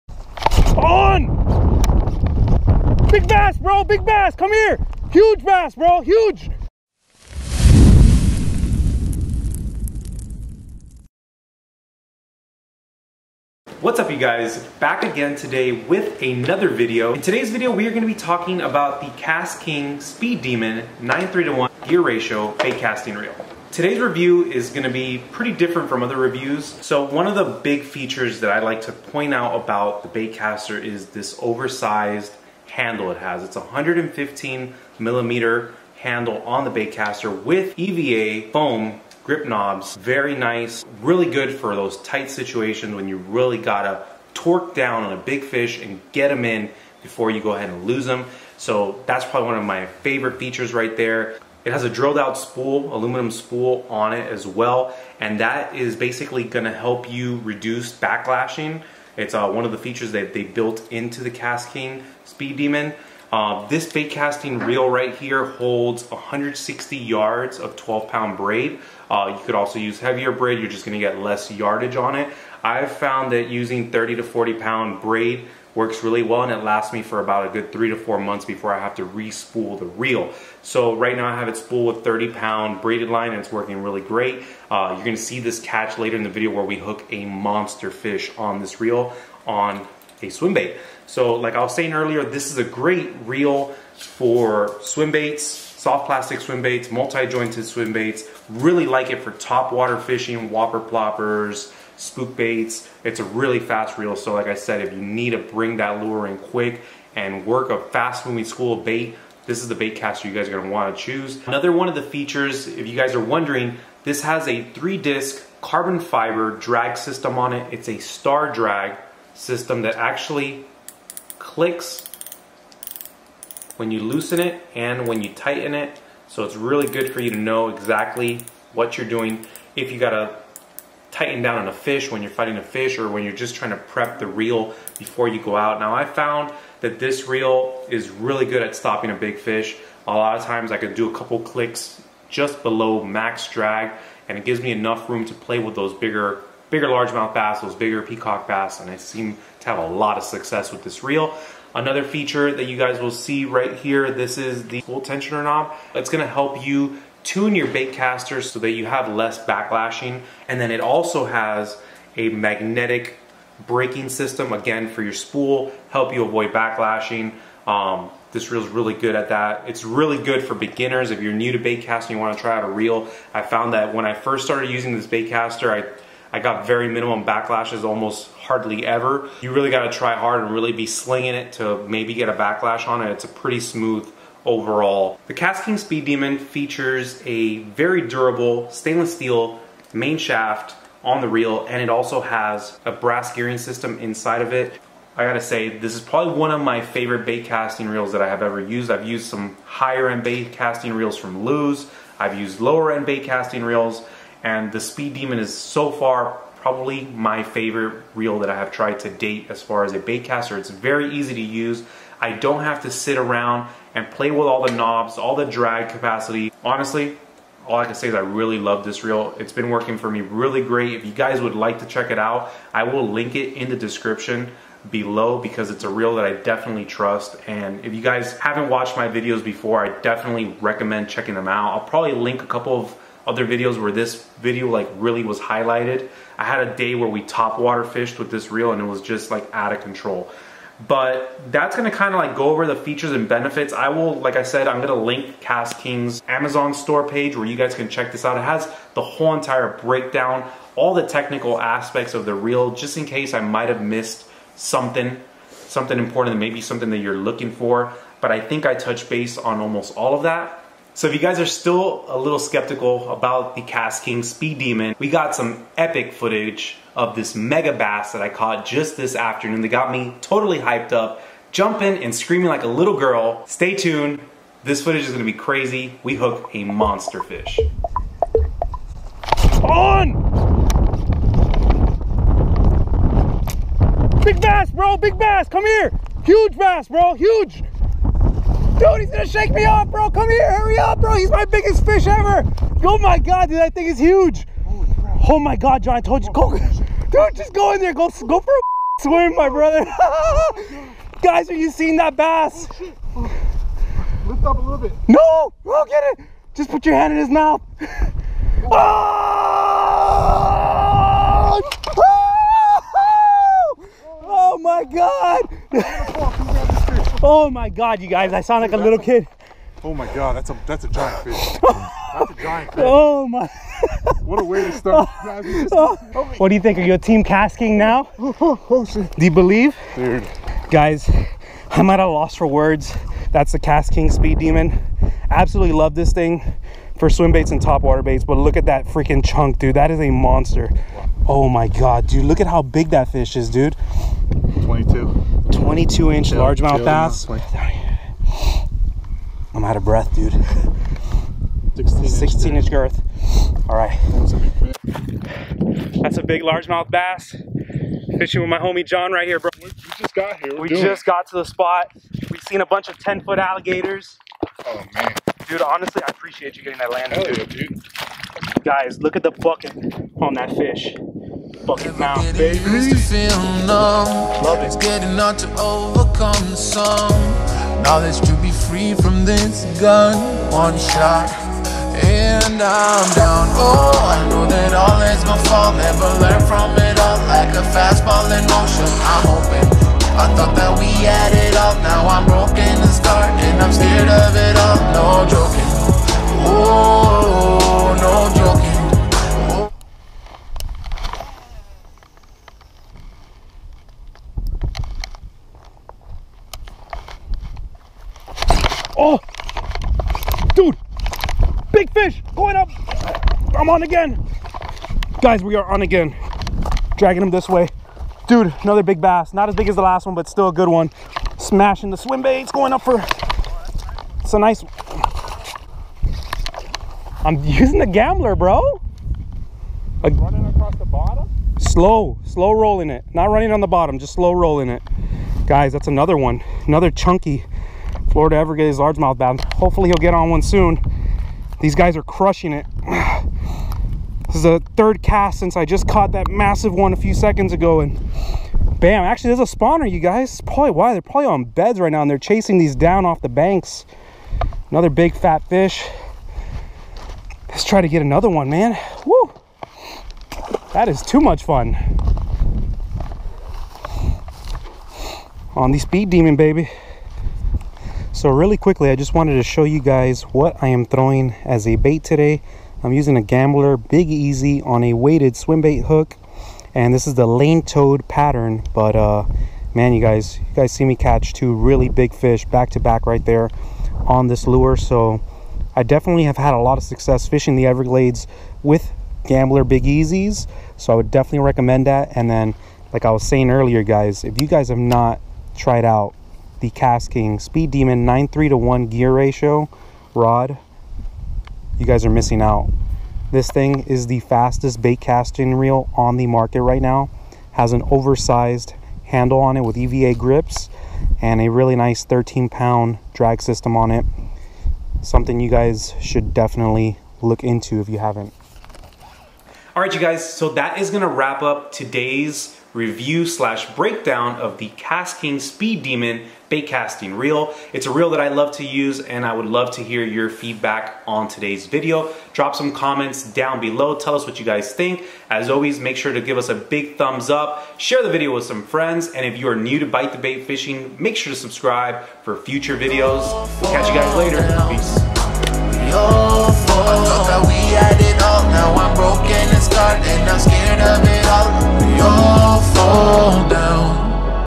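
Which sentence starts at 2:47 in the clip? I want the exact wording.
Um, this reel is really good at that.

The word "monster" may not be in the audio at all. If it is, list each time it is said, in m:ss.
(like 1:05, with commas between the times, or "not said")
1:27, 4:36, 5:40.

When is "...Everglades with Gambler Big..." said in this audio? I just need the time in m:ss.
8:07.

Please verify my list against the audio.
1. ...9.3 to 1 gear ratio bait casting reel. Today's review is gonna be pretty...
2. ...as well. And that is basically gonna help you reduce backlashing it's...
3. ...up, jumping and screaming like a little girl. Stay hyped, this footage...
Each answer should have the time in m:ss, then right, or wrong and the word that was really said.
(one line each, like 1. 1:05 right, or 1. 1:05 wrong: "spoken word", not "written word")
1. 0:21 right
2. 0:54 right
3. 4:30 wrong: "tuned", not "hyped".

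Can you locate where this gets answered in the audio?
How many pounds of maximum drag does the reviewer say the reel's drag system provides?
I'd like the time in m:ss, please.
8:32.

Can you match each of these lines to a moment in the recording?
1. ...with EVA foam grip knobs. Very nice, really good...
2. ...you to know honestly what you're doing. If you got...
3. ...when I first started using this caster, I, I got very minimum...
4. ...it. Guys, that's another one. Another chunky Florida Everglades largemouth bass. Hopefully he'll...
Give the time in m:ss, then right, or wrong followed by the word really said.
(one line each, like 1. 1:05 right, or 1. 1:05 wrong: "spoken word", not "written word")
1. 0:37 right
2. 2:07 wrong: "exactly", not "honestly"
3. 2:53 right
4. 7:14 right.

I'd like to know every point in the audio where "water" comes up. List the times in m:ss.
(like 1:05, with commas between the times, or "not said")
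1:39, 3:57, 5:37.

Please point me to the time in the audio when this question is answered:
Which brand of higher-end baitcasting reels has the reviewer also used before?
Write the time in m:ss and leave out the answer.
3:21.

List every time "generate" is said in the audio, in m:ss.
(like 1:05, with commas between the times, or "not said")
not said.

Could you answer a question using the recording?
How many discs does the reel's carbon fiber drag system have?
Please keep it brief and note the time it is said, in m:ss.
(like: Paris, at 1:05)
3, at 1:54.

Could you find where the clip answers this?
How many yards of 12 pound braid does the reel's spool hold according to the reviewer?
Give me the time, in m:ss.
1:06.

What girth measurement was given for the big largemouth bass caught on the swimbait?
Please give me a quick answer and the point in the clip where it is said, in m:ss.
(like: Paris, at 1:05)
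16 inch, at 5:52.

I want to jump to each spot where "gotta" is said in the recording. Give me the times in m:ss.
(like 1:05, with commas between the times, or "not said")
0:43, 2:59, 3:15.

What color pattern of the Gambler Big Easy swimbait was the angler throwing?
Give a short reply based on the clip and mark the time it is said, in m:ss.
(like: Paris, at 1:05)
Lane toad, at 7:57.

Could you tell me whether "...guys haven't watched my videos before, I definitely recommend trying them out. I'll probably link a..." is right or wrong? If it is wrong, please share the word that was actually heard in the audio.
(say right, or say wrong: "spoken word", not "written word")
wrong: "checking", not "trying".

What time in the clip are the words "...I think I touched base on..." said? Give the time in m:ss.
4:18.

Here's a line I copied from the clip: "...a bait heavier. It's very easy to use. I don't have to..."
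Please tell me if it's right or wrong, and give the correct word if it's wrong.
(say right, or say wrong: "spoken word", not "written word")
wrong: "caster", not "heavier".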